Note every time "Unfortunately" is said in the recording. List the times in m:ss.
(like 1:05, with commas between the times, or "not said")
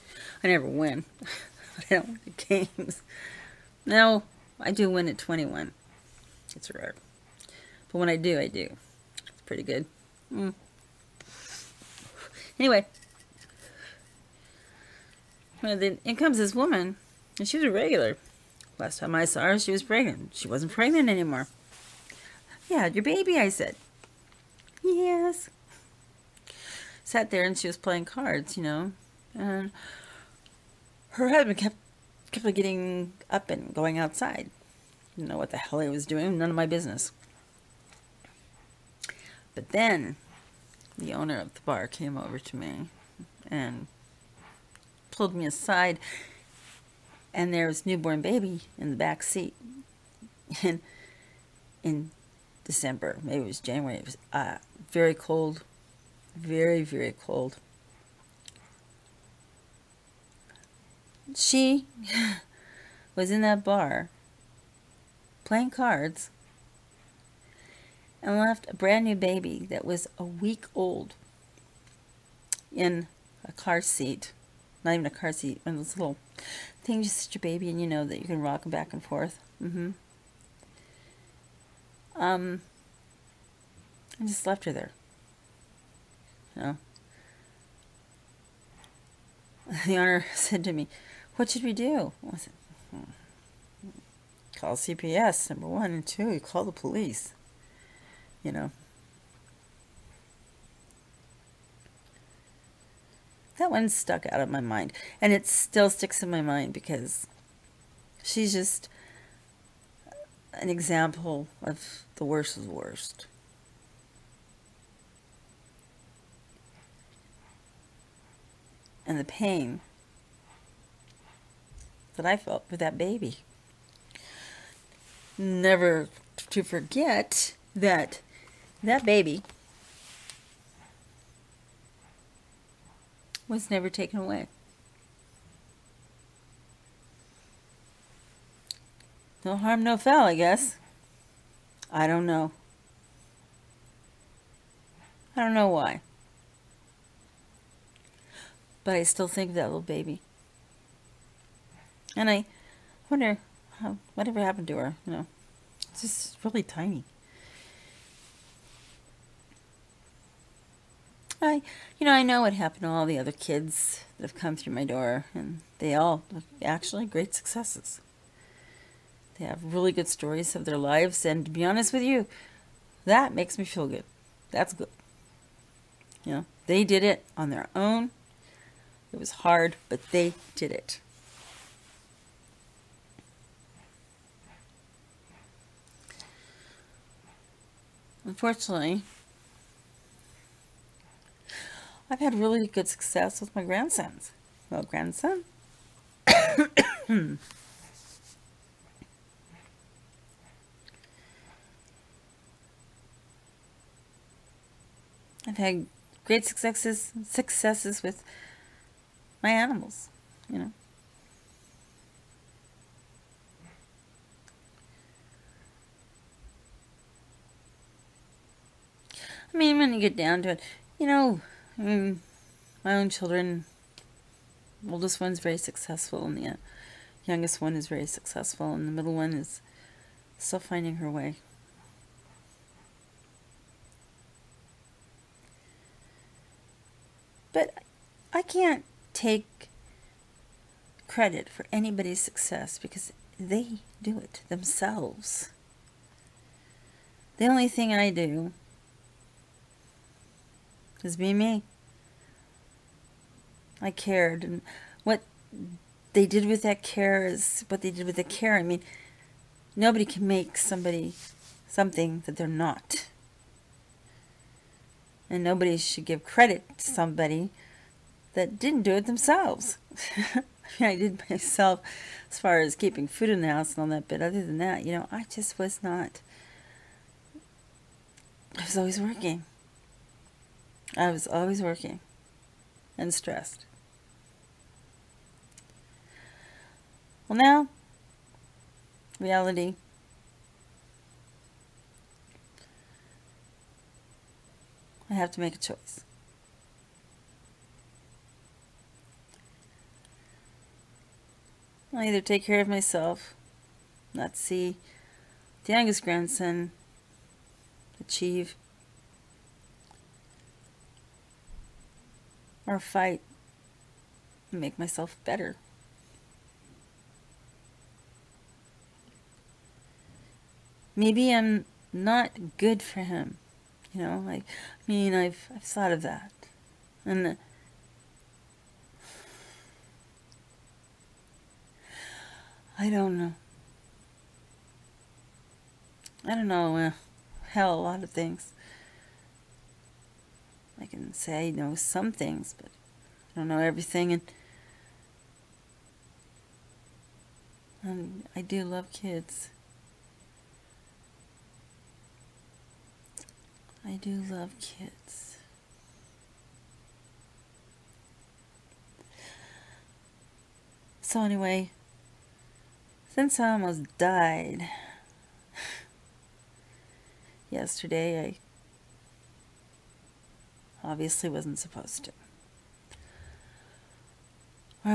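3:08.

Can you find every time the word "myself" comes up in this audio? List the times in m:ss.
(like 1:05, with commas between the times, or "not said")
4:31, 5:02, 5:14.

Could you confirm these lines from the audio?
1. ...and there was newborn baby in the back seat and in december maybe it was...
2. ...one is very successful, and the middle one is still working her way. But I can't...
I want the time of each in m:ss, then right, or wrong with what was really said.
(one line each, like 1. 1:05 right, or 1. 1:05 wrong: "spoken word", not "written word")
1. 0:47 right
2. 3:47 wrong: "finding", not "working".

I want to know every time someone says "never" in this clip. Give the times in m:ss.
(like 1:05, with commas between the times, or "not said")
0:00, 2:05, 2:13.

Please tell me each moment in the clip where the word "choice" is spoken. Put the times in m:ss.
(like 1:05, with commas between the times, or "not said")
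4:55.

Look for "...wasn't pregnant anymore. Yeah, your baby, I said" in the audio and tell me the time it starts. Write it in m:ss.
0:20.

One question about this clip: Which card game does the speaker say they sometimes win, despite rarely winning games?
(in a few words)
21.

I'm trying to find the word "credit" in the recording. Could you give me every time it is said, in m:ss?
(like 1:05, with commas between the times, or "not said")
4:01, 4:26.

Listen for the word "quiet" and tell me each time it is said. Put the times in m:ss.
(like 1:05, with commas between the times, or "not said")
not said.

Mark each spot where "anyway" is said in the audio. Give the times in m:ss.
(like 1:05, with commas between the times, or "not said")
0:12, 6:01.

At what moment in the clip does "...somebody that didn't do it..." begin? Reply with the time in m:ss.
4:26.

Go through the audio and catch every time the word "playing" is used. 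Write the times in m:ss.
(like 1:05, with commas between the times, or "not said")
0:27, 1:05.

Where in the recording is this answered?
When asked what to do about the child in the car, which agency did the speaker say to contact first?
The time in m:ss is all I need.
1:34.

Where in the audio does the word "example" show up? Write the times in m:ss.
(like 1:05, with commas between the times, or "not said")
1:50.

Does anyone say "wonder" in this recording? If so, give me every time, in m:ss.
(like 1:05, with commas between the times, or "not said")
2:33.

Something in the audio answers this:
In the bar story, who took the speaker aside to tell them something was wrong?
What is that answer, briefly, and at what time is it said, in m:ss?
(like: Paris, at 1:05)
The owner of the bar, at 0:40.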